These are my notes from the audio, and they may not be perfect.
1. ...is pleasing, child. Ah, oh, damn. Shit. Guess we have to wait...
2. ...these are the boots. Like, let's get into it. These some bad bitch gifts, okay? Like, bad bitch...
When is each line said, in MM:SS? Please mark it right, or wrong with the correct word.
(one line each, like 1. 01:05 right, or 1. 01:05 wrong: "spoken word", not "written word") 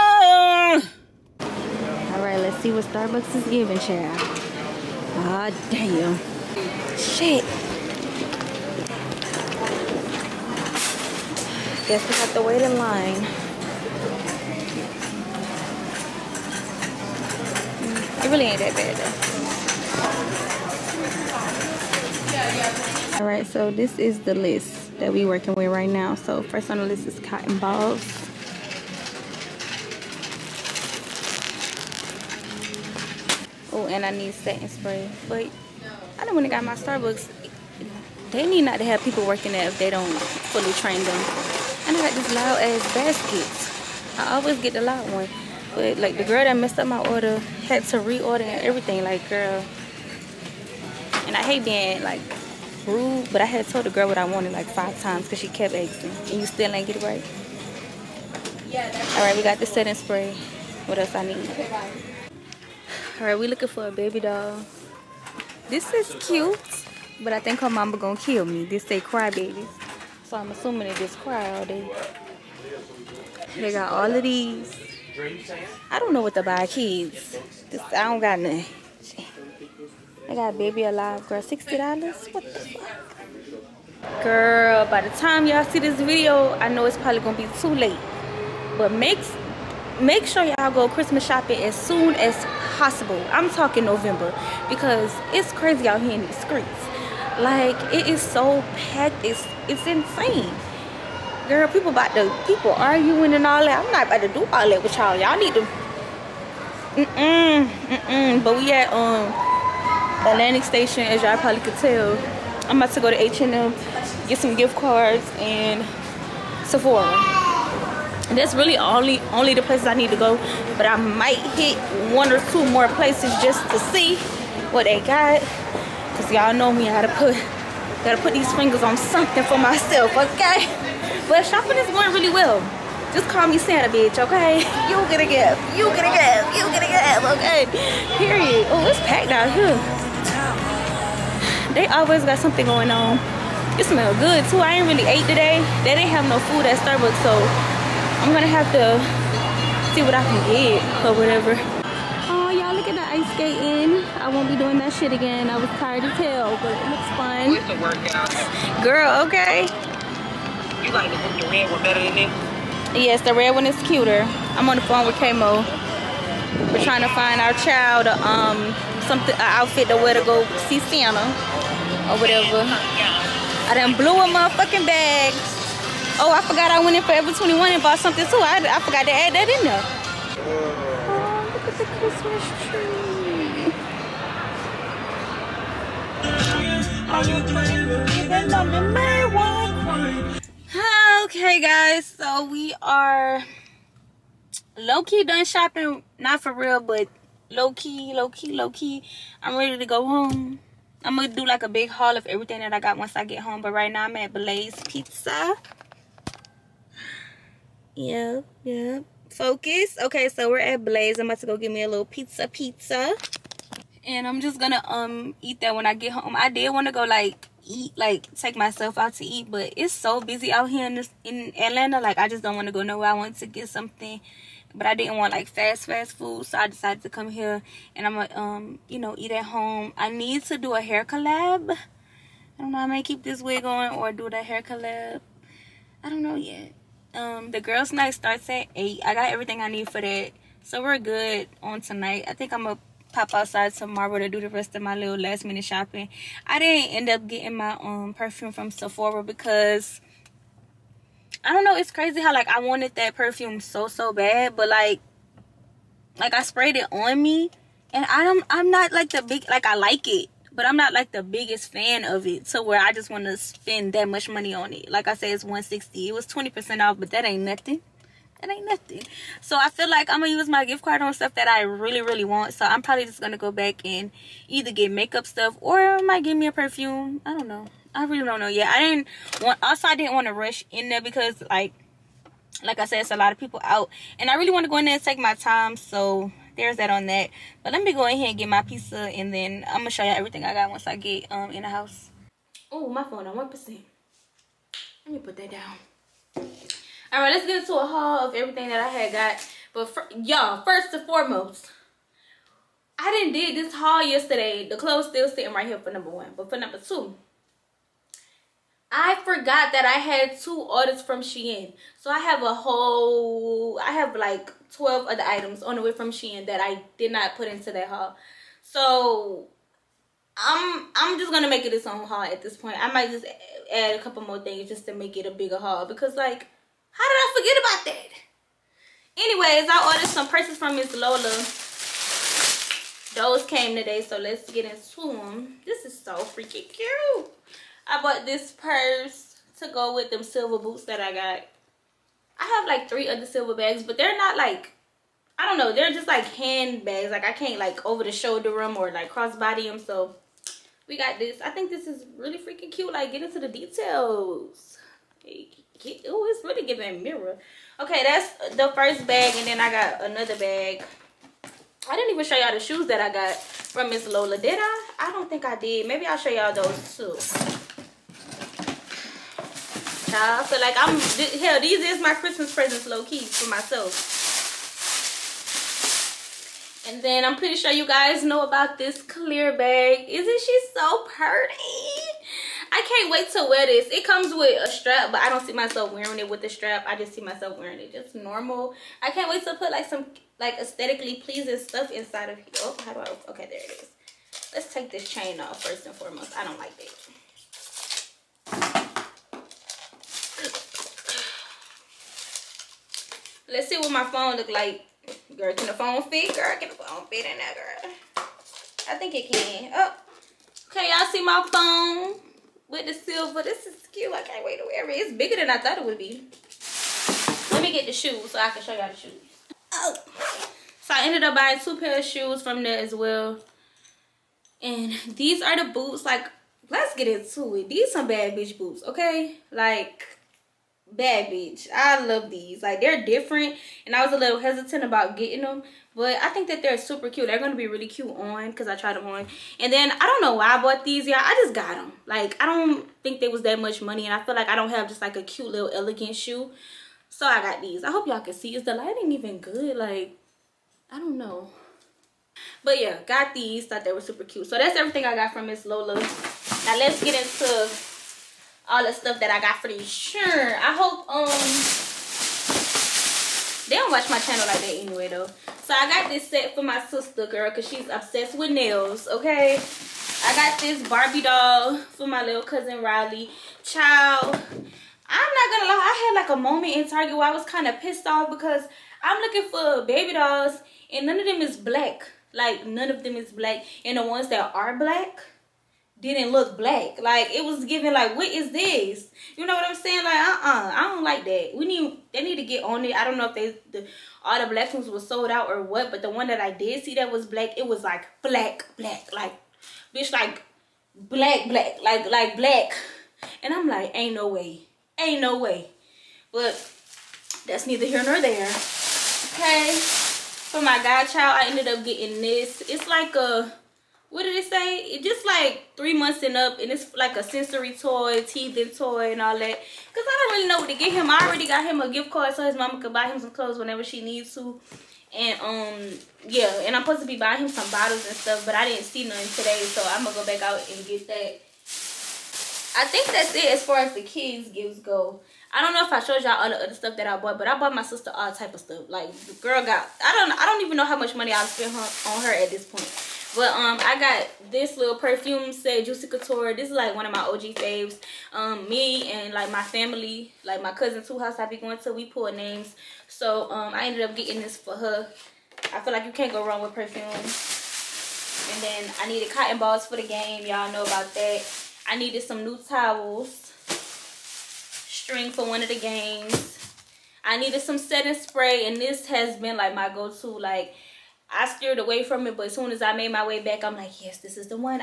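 1. 00:03 wrong: "giving", not "pleasing"
2. 07:05 wrong: "boots", not "gifts".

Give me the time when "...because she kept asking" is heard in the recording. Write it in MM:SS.
00:55.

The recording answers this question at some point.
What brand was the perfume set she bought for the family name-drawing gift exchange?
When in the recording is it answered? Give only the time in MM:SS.
09:05.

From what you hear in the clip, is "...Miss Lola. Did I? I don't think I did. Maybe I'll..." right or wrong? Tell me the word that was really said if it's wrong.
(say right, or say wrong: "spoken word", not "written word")
right.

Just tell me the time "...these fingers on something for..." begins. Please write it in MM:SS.
02:08.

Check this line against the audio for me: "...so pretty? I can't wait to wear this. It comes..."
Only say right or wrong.
right.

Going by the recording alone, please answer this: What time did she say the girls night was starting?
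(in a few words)
8.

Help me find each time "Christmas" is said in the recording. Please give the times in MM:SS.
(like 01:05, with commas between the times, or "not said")
01:30, 03:02, 06:12.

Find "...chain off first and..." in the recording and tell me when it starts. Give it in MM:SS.
06:35.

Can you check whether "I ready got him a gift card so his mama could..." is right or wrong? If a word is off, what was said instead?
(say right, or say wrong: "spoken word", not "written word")
wrong: "already", not "ready".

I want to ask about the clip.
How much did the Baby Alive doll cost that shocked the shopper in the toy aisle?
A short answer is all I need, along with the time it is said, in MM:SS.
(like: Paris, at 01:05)
$60, at 01:21.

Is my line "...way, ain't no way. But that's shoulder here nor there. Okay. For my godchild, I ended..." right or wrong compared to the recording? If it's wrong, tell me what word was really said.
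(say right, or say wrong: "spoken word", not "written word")
wrong: "neither", not "shoulder".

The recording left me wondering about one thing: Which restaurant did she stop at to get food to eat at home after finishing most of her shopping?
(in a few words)
Blaze Pizza.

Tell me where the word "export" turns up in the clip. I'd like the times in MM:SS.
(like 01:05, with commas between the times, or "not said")
not said.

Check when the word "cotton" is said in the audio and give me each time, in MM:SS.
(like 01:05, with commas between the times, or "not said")
00:27, 09:19.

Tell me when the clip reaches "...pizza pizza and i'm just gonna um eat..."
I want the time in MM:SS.
03:32.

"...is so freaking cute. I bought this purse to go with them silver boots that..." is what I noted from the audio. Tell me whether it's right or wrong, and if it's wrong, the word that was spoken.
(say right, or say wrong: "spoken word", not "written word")
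right.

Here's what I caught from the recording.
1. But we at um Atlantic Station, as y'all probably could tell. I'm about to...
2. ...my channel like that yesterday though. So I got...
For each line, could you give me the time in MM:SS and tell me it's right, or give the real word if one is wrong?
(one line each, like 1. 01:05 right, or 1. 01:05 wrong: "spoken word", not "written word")
1. 01:48 right
2. 07:44 wrong: "anyway", not "yesterday".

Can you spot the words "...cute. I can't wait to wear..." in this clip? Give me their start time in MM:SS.
06:53.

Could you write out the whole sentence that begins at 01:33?
I'm talking November because it's crazy out here in these streets.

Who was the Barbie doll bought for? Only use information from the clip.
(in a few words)
Riley.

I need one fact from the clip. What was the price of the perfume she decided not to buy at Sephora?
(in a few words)
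160.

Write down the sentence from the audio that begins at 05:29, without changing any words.
Anyways, I ordered some purses from Miss Lola.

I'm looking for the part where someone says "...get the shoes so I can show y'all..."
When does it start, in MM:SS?
06:57.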